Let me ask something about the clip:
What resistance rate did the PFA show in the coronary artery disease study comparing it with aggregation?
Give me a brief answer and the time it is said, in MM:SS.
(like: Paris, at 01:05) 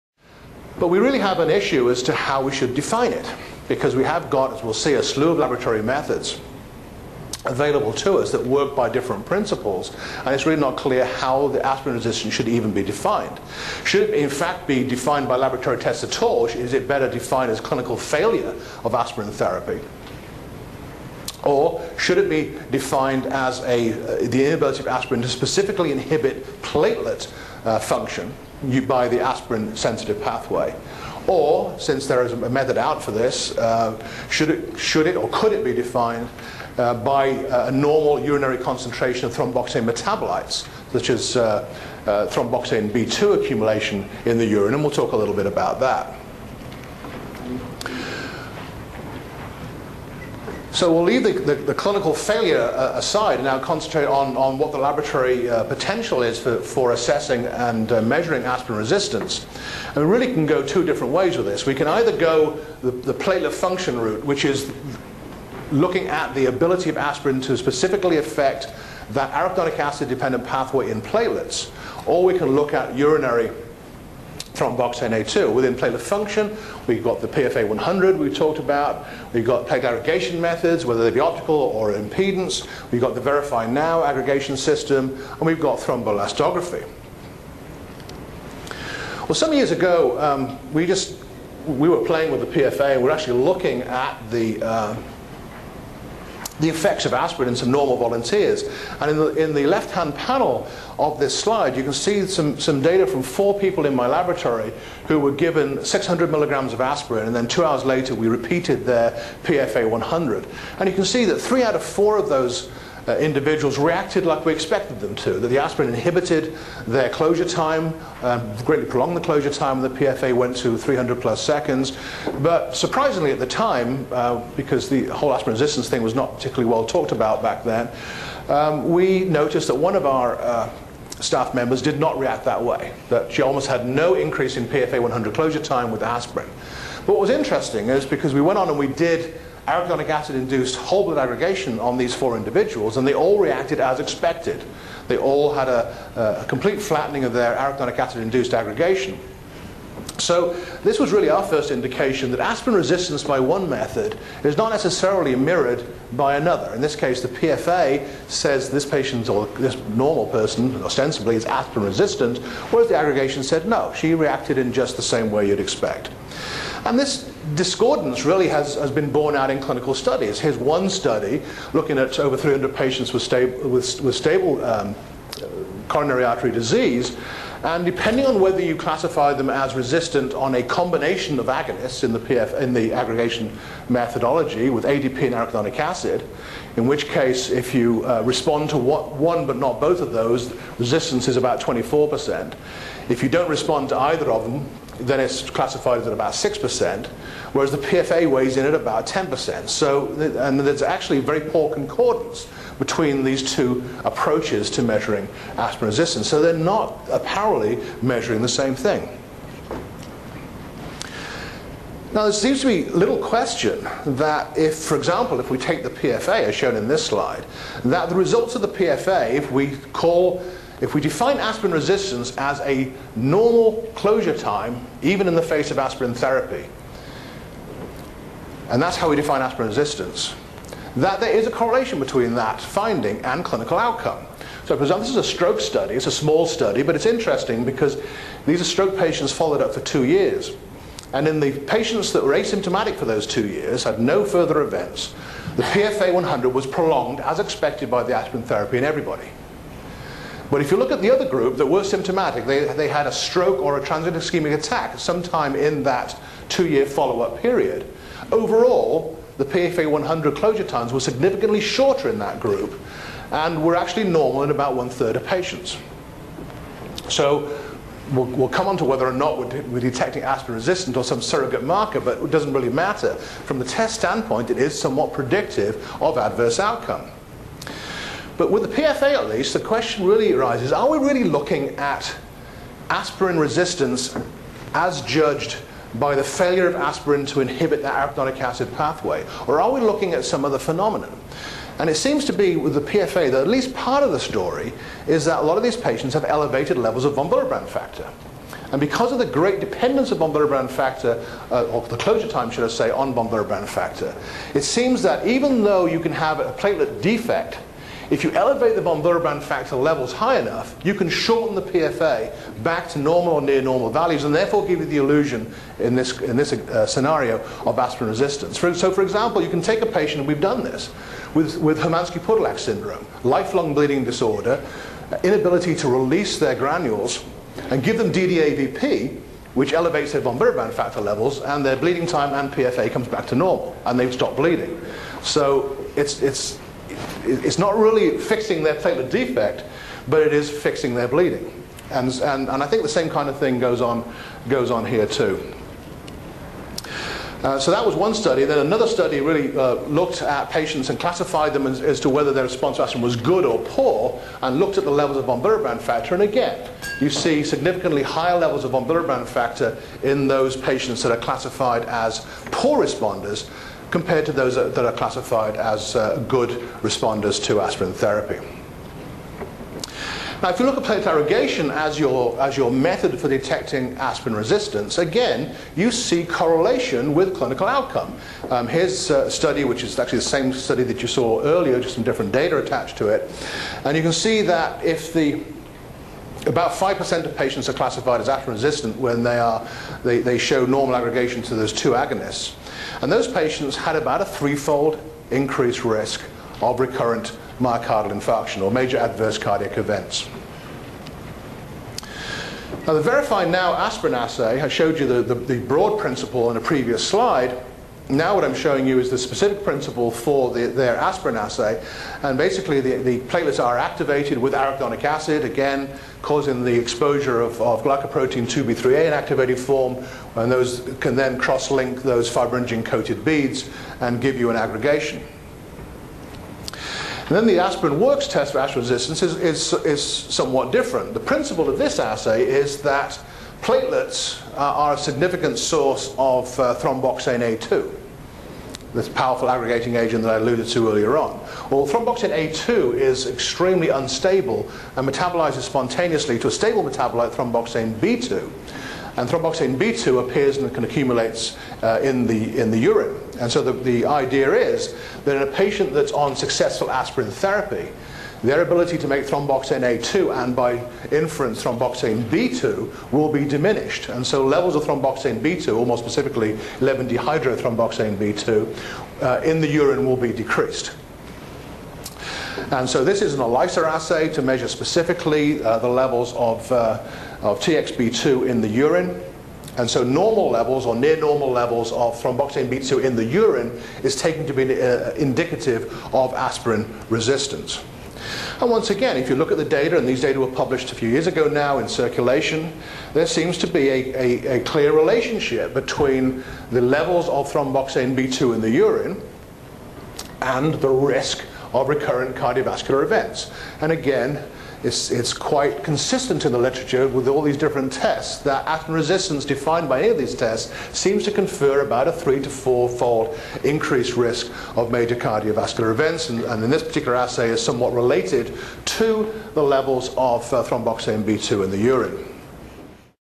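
10%, at 03:19.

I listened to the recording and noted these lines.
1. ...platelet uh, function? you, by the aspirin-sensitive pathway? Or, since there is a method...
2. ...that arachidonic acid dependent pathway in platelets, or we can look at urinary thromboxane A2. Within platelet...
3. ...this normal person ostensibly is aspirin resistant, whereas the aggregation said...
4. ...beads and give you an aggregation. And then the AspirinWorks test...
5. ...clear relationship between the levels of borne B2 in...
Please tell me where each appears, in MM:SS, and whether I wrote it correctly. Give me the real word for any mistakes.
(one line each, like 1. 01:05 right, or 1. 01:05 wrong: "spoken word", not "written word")
1. 00:26 right
2. 01:09 right
3. 02:39 right
4. 07:03 right
5. 08:14 wrong: "thromboxane", not "borne".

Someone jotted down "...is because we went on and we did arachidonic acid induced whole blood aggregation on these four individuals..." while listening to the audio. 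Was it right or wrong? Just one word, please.
right.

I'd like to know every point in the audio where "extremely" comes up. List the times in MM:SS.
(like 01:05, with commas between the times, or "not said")
07:23.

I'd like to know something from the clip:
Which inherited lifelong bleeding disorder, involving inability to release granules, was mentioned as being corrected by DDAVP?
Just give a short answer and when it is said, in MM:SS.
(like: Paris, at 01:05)
Hermansky-Pudlak syndrome, at 05:21.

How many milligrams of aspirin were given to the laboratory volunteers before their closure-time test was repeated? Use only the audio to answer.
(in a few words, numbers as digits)
600.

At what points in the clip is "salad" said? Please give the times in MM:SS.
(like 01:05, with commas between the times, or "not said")
not said.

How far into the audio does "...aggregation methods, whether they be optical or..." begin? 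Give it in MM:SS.
01:19.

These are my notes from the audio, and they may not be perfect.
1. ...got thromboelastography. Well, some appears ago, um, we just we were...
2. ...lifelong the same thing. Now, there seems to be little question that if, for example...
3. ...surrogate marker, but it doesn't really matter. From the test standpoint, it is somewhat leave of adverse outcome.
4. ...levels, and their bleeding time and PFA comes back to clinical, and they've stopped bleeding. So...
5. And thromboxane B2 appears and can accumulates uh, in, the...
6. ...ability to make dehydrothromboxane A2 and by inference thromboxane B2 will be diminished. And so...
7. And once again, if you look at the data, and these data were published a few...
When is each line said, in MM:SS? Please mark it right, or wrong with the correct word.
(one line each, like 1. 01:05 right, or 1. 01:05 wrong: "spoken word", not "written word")
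1. 01:25 wrong: "years", not "appears"
2. 03:28 wrong: "measuring", not "lifelong"
3. 04:31 wrong: "predictive", not "leave"
4. 05:30 wrong: "normal", not "clinical"
5. 07:29 right
6. 07:38 wrong: "thromboxane", not "dehydrothromboxane"
7. 08:08 right.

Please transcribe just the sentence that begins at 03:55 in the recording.
It's a small study, but it's interesting because these are stroke patients followed up for two years.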